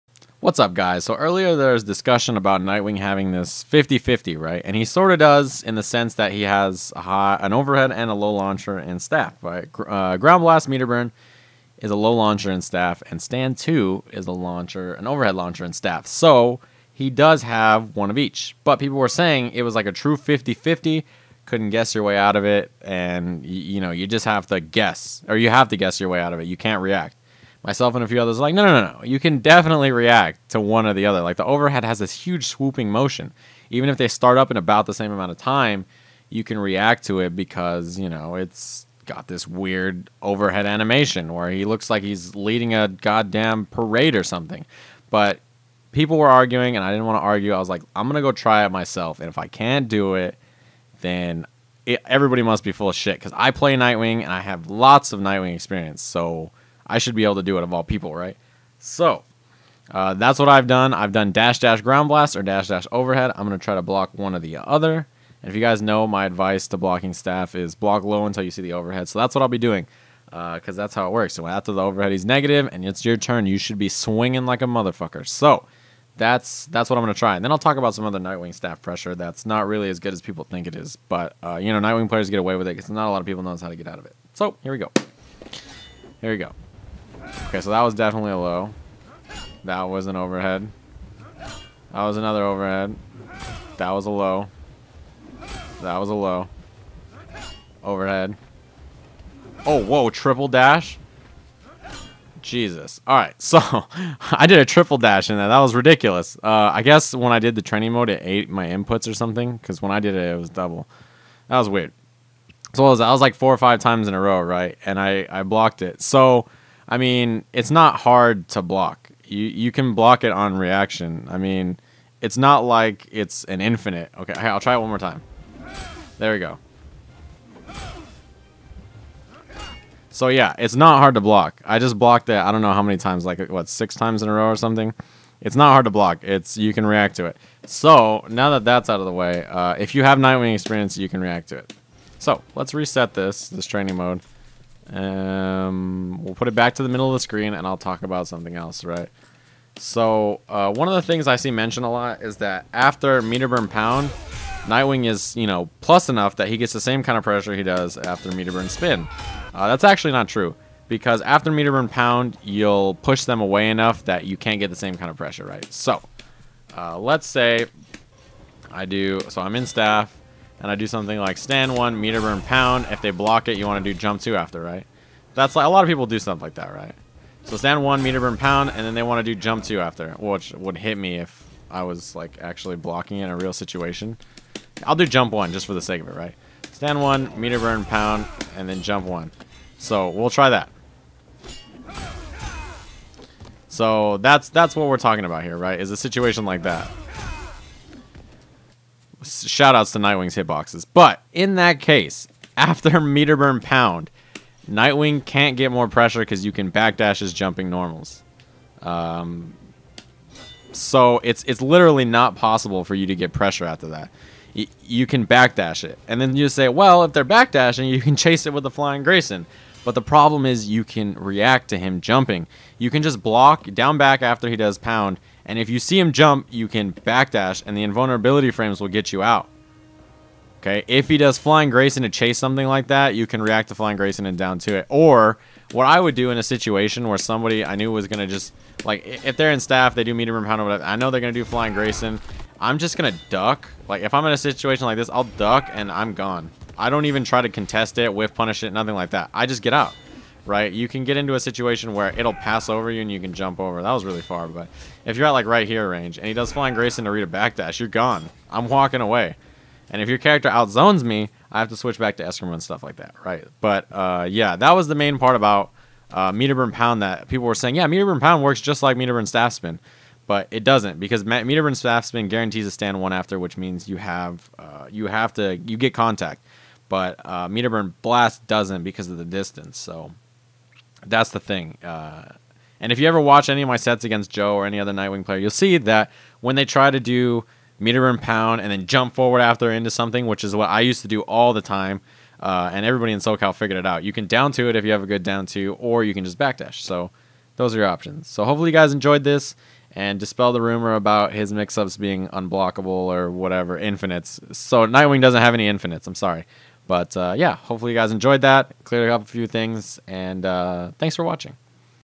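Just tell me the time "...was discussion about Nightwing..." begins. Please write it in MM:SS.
00:01.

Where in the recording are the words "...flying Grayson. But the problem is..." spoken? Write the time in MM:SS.
03:38.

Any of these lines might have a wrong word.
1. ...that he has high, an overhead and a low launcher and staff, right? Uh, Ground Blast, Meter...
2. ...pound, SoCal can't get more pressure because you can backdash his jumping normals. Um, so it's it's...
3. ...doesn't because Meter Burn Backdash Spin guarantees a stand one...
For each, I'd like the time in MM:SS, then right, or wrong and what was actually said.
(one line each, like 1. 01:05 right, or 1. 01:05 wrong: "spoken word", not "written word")
1. 00:06 right
2. 03:23 wrong: "Nightwing", not "SoCal"
3. 04:30 wrong: "Staff", not "Backdash".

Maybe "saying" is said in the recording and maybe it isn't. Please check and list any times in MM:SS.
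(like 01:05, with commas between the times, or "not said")
00:19, 04:27.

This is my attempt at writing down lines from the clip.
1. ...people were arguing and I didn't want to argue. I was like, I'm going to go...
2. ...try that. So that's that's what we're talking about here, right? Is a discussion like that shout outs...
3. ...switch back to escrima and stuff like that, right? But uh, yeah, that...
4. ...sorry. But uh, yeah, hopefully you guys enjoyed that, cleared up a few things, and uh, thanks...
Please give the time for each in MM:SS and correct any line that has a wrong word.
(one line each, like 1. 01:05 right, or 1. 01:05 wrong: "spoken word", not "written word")
1. 00:45 right
2. 03:10 wrong: "situation", not "discussion"
3. 04:21 right
4. 05:06 right.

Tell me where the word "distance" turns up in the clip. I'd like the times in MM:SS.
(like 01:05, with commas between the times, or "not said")
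04:39.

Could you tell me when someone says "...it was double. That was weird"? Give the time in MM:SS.
01:50.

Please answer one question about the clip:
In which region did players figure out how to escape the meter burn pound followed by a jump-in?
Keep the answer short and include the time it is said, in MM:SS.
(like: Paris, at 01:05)
SoCal, at 04:53.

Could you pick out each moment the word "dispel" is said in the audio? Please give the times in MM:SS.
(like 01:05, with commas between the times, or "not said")
05:00.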